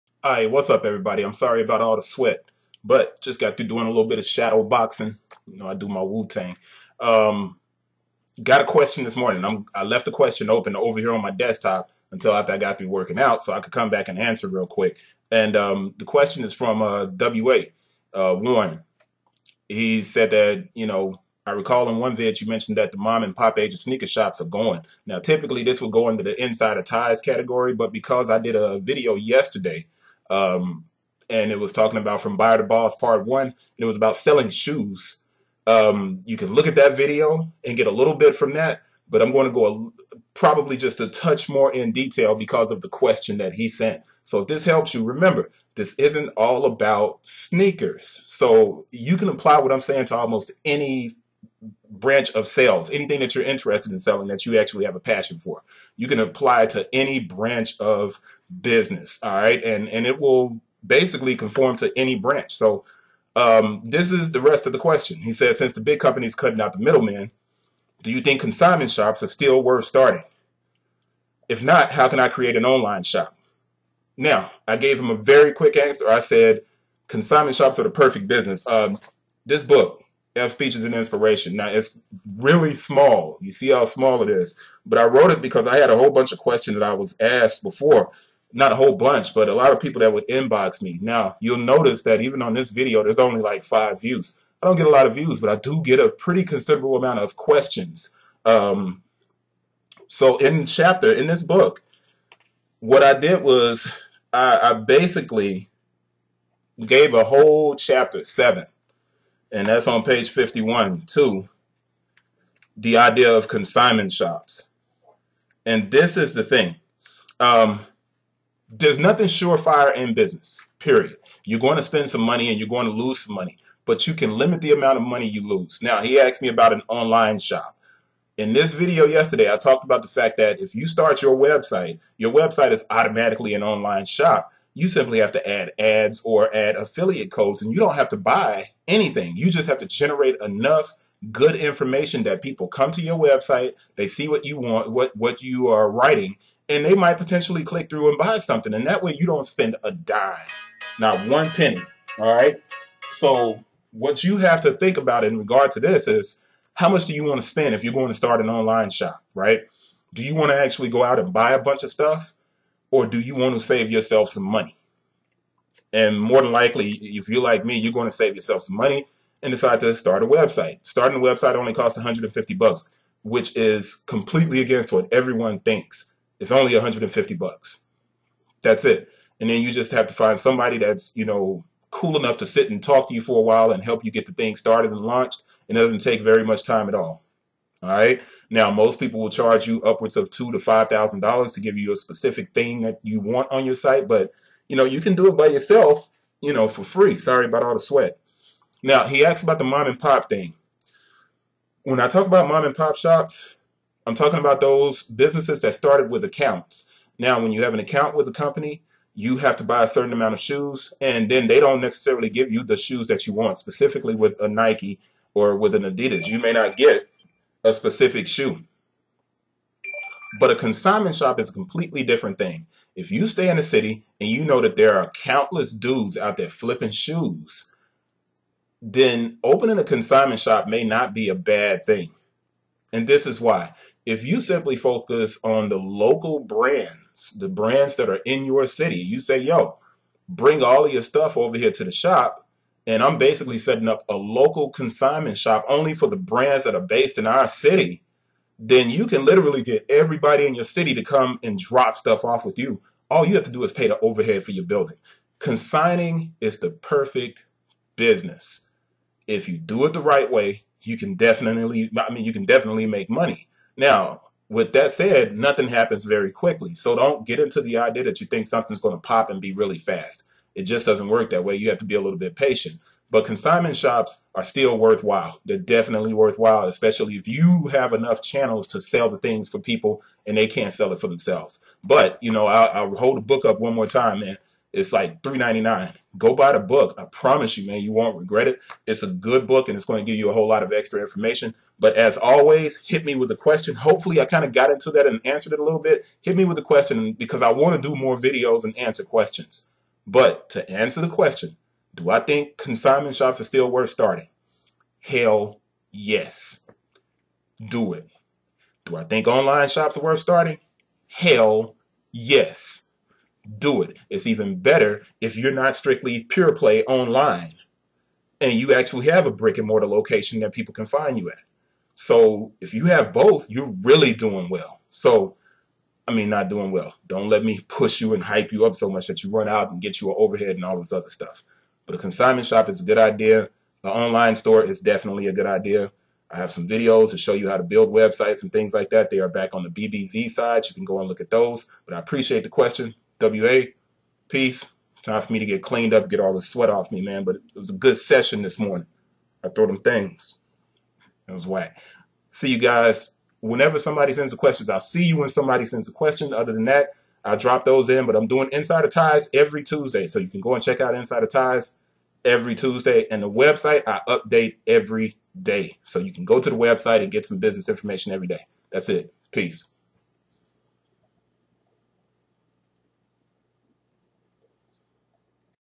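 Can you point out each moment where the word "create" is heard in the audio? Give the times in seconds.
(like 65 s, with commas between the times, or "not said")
72 s.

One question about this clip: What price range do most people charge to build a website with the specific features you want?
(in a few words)
$2,000 to $5,000.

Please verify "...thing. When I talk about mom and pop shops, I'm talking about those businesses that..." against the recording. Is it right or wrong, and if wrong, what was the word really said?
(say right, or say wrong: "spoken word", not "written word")
right.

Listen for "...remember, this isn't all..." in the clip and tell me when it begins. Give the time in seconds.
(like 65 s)
45 s.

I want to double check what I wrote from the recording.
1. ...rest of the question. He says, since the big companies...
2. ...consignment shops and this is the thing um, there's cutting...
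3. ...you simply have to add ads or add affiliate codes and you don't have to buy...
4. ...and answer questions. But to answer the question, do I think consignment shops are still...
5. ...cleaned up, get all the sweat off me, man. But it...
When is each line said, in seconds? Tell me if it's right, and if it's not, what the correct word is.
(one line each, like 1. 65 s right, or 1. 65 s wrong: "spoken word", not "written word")
1. 64 s right
2. 113 s wrong: "nothing", not "cutting"
3. 134 s right
4. 298 s right
5. 345 s right.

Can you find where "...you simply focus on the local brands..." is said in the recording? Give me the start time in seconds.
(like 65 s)
234 s.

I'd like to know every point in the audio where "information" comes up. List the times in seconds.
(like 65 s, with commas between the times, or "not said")
141 s, 291 s, 367 s.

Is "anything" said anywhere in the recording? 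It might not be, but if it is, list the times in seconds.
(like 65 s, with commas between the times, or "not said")
52 s, 138 s.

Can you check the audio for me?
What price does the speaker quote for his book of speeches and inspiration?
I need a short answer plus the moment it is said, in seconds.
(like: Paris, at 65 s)
$3.99, at 285 s.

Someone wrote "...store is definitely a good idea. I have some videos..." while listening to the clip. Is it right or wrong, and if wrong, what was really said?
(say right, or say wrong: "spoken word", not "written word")
right.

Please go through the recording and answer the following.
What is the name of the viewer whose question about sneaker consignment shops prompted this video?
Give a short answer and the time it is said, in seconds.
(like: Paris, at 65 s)
Warren, at 18 s.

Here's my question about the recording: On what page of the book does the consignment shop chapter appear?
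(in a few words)
51.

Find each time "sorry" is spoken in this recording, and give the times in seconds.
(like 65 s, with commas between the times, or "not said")
1 s, 197 s.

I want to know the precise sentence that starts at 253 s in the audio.
All you have to do is pay the overhead for your building.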